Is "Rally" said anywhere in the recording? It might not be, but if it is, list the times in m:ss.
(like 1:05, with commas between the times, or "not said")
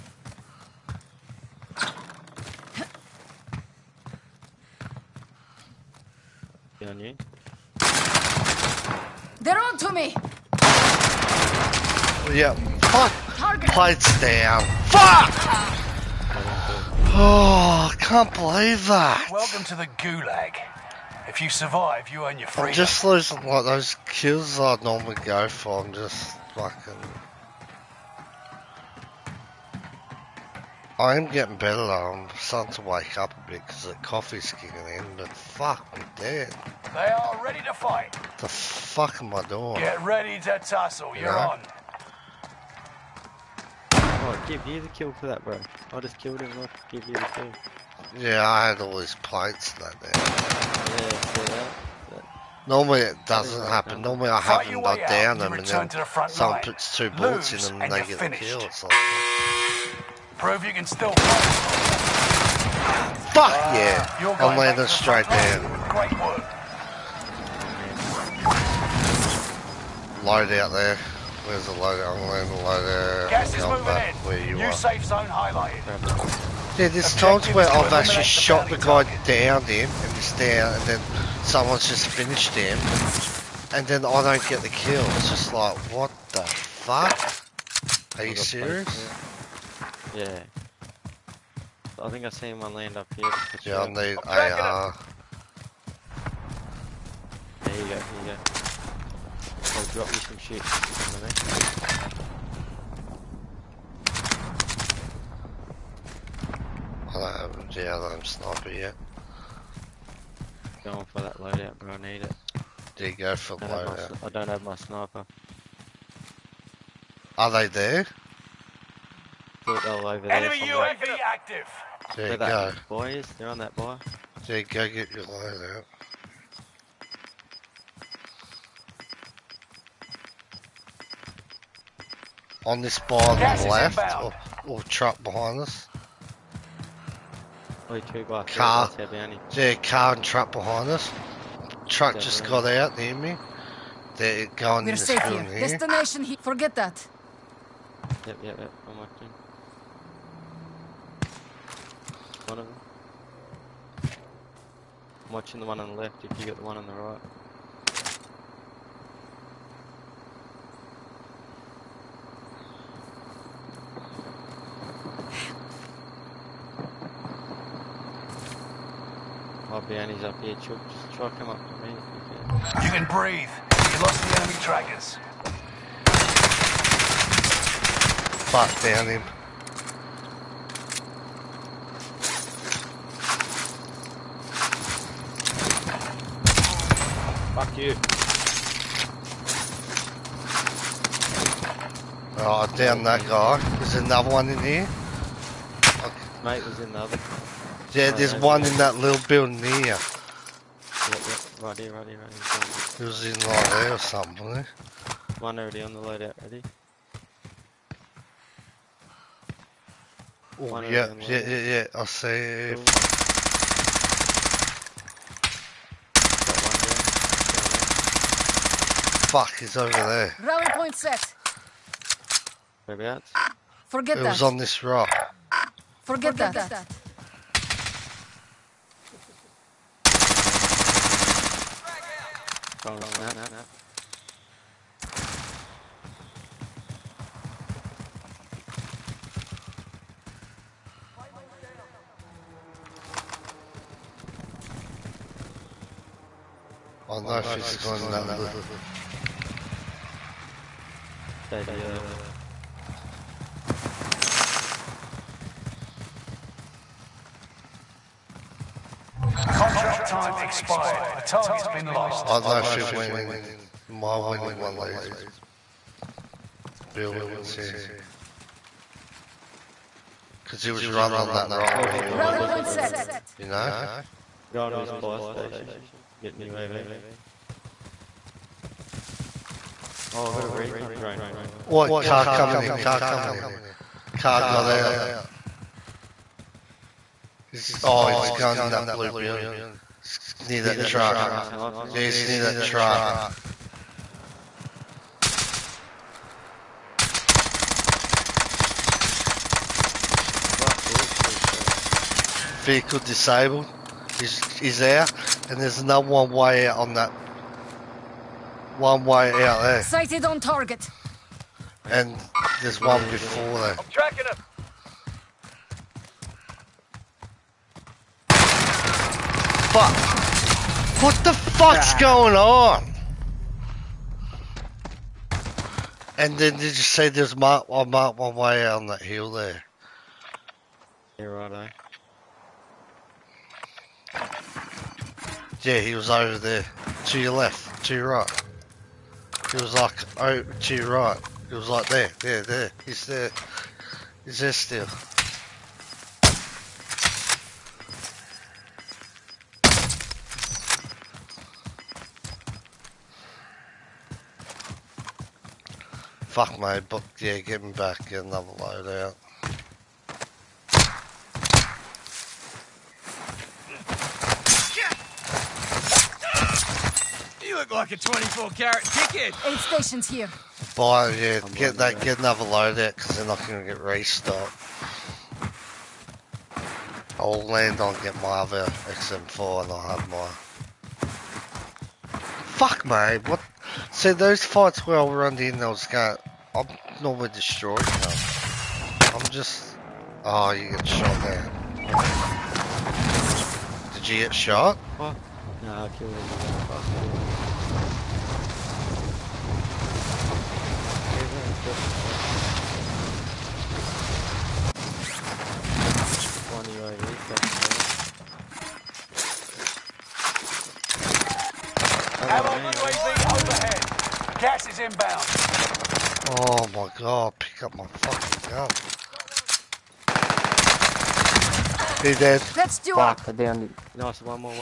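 3:40, 4:32.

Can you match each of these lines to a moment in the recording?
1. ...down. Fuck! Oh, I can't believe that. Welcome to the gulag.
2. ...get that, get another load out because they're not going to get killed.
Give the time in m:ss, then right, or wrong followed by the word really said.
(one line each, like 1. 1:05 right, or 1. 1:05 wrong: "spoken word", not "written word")
1. 0:14 right
2. 6:11 wrong: "restocked", not "killed".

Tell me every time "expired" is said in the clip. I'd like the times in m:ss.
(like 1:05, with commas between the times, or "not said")
4:20.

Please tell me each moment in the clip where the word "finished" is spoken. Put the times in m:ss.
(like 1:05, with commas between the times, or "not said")
0:58, 1:22.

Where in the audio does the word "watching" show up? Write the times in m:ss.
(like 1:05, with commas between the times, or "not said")
2:28, 2:35.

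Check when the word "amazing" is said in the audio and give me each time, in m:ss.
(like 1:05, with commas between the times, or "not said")
not said.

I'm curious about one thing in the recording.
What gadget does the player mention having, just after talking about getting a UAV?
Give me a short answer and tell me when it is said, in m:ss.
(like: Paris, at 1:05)
Recon drone, at 4:40.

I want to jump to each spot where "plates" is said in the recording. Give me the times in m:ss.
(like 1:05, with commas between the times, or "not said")
0:13, 0:49.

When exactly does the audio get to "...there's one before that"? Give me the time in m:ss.
5:12.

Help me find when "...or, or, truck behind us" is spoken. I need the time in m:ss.
2:14.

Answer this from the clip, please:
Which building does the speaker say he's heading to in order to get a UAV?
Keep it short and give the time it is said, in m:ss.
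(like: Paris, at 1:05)
Fire station, at 4:34.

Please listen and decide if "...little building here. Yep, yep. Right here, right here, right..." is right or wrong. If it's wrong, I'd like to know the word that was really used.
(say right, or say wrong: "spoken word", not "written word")
right.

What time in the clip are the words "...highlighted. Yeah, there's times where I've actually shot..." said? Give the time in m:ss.
1:15.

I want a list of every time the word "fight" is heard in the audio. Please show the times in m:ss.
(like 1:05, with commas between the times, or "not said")
0:37, 1:01, 6:24.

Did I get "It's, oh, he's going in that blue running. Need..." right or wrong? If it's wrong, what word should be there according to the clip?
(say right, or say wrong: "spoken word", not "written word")
wrong: "building", not "running".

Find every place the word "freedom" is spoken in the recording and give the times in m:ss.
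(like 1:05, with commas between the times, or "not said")
0:22.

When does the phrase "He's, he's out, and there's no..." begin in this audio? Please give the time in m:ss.
5:04.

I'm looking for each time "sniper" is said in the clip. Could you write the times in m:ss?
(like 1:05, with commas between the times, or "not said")
1:48, 1:54.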